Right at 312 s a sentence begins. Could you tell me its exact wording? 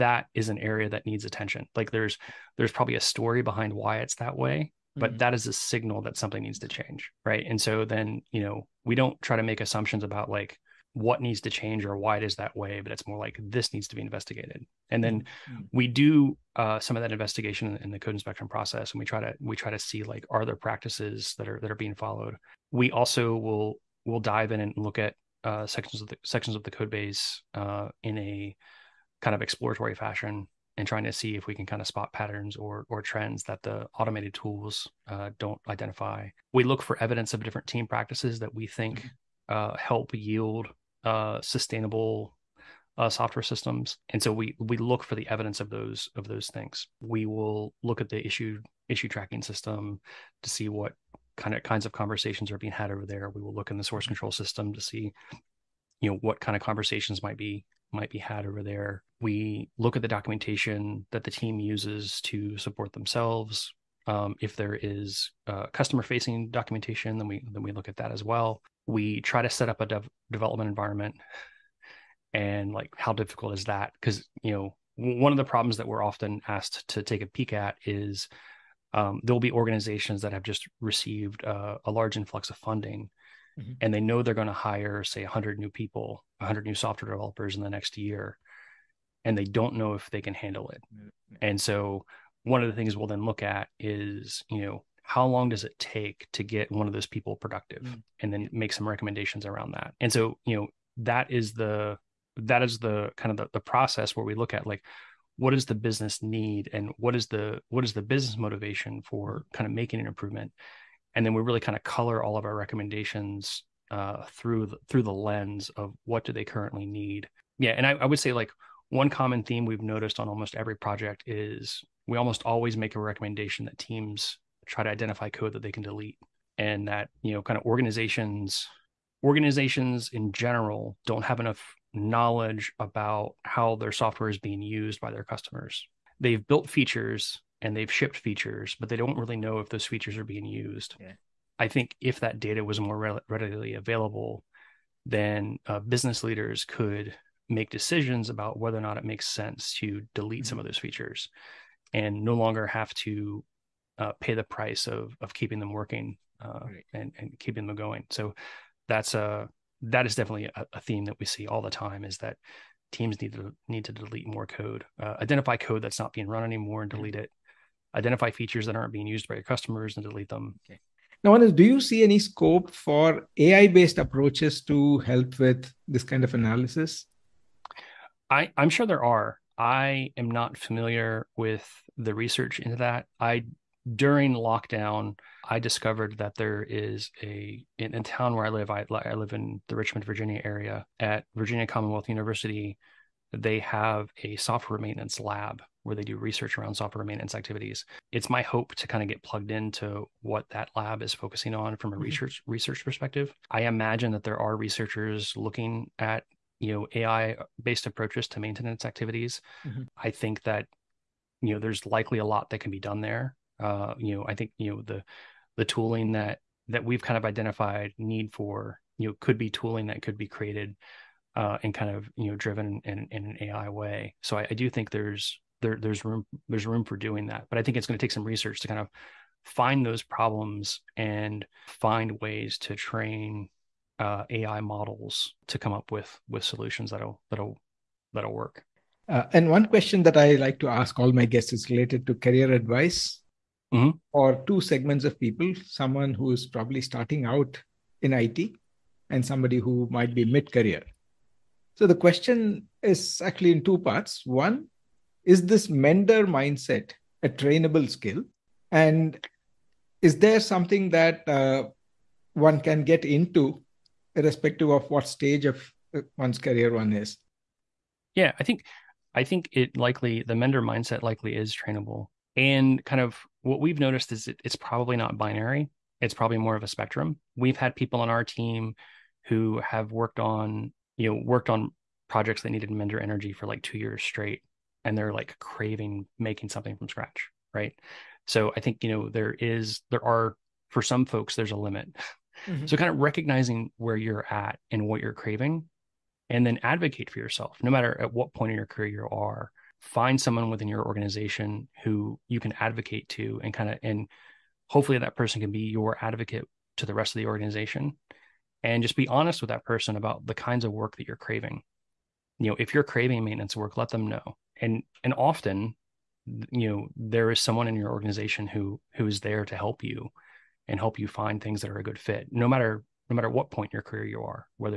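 You know, if you're craving maintenance work, let them know.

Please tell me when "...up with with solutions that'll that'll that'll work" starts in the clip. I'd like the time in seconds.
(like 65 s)
235 s.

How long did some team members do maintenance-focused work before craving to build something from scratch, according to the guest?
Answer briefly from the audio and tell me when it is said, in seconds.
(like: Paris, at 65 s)
2 years, at 283 s.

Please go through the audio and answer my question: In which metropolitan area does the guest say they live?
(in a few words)
Richmond, Virginia.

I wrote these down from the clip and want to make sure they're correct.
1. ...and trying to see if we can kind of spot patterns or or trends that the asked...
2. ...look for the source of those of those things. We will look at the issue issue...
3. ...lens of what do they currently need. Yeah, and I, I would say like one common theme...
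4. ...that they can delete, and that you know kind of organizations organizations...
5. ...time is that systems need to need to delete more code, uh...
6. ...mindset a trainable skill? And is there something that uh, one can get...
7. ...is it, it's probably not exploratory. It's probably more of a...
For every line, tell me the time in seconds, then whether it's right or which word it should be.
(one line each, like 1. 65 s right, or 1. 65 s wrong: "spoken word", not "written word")
1. 30 s wrong: "automated", not "asked"
2. 44 s wrong: "evidence", not "source"
3. 115 s right
4. 125 s right
5. 161 s wrong: "teams", not "systems"
6. 256 s right
7. 274 s wrong: "binary", not "exploratory".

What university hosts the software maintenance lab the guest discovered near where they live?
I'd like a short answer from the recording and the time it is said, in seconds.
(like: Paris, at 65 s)
Virginia Commonwealth University, at 191 s.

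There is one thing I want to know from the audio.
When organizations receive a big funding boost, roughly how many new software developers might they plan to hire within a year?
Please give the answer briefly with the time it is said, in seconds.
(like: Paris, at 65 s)
100, at 86 s.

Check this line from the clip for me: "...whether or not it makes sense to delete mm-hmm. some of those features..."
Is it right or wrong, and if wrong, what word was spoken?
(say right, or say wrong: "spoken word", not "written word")
right.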